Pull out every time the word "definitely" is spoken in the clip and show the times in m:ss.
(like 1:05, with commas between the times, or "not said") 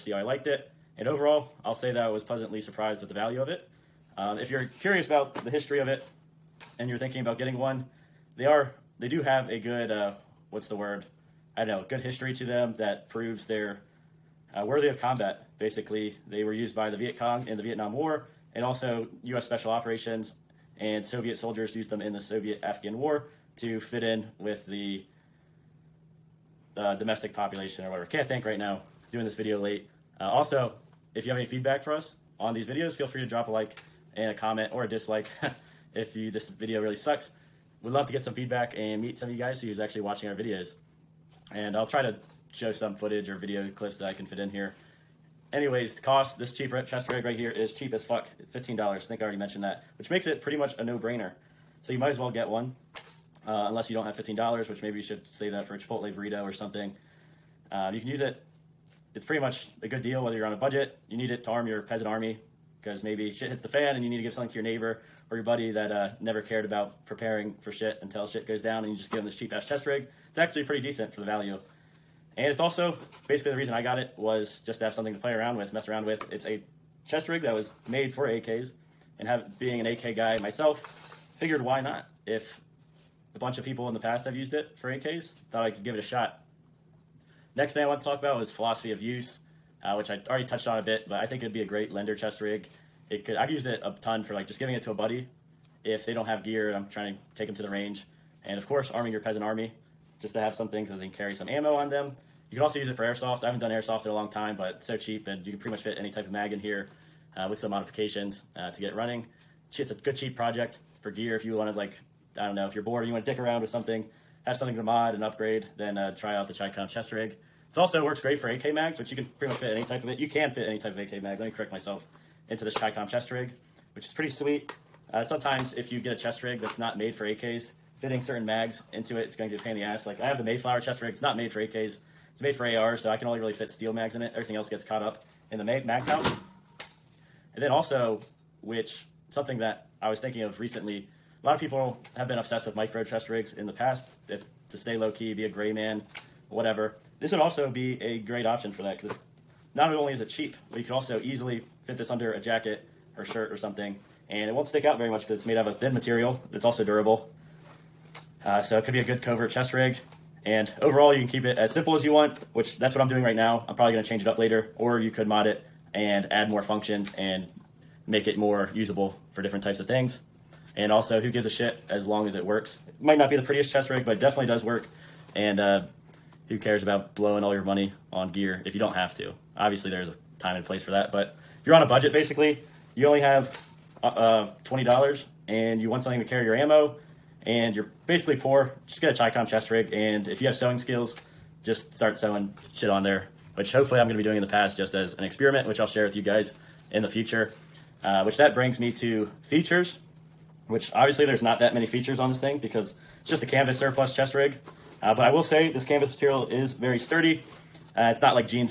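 2:54.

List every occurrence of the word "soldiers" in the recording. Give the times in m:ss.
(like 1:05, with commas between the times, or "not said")
0:21.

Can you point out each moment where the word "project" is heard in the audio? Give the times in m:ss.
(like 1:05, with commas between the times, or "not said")
1:50.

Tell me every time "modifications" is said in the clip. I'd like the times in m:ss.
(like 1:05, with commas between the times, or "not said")
1:47.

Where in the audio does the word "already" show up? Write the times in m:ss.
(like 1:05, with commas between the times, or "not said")
0:49, 1:30.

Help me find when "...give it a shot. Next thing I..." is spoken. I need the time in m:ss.
1:25.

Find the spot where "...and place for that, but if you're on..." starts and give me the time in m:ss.
3:00.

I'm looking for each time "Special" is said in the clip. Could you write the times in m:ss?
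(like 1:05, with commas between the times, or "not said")
0:19.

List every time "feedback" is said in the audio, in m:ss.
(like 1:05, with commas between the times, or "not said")
0:31, 0:38.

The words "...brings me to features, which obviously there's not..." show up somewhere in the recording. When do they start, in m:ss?
3:18.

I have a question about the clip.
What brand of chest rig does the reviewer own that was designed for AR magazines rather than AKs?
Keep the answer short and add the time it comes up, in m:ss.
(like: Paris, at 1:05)
Mayflower, at 2:10.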